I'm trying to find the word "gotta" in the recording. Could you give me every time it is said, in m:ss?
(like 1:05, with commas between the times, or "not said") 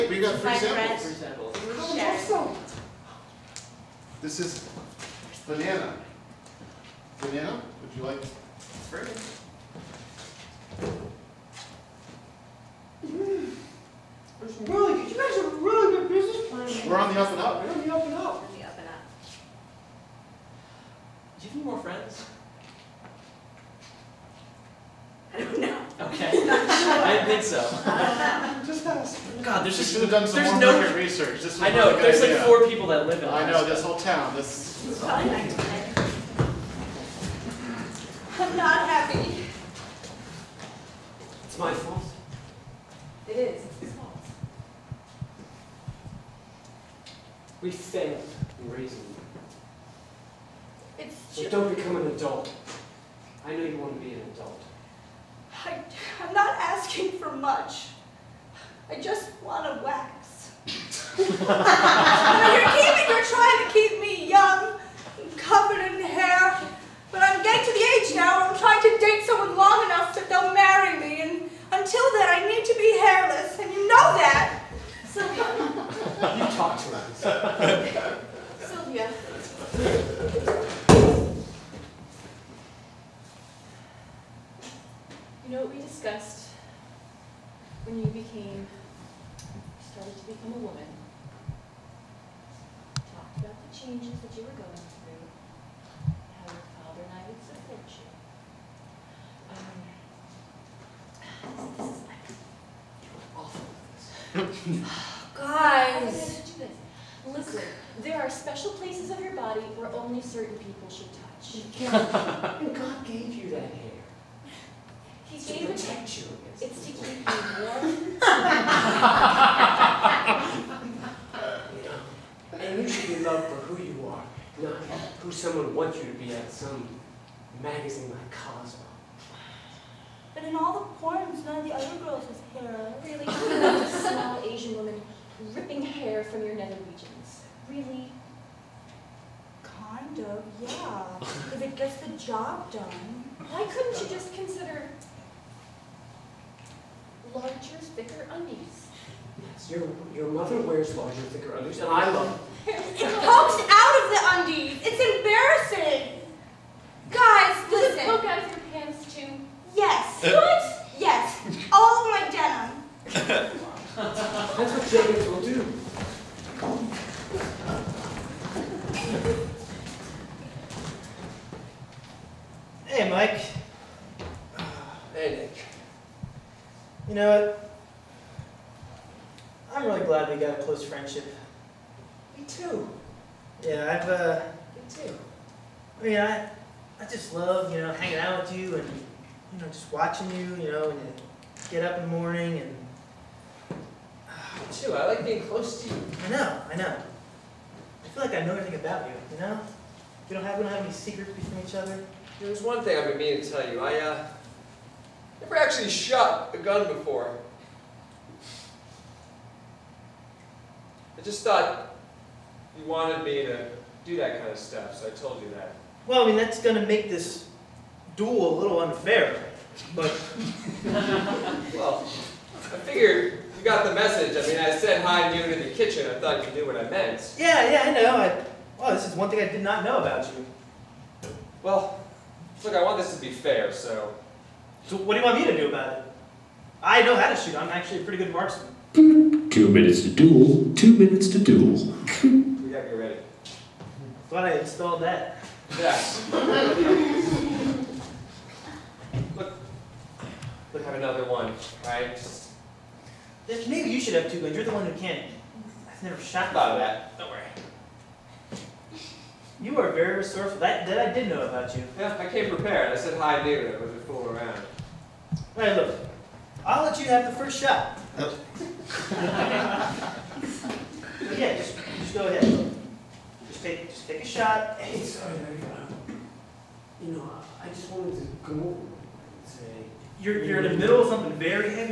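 4:02.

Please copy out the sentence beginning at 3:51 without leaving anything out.
Well, look, I want this to be fair, so...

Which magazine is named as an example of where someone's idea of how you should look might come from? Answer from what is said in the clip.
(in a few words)
Cosmo.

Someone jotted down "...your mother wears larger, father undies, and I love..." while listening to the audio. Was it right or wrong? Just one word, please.
wrong.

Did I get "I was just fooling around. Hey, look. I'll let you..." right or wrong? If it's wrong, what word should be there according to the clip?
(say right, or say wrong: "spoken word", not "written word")
right.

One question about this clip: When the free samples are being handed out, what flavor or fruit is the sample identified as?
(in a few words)
banana.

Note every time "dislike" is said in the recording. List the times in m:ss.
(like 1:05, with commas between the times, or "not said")
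not said.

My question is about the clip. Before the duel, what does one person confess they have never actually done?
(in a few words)
shot a gun.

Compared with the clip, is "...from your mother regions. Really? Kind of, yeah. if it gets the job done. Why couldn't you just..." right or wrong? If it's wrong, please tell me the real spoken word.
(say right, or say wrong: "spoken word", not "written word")
wrong: "nether", not "mother".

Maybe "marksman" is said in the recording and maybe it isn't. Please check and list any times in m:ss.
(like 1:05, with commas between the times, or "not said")
3:58.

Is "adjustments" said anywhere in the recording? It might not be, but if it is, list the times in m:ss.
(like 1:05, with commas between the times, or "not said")
not said.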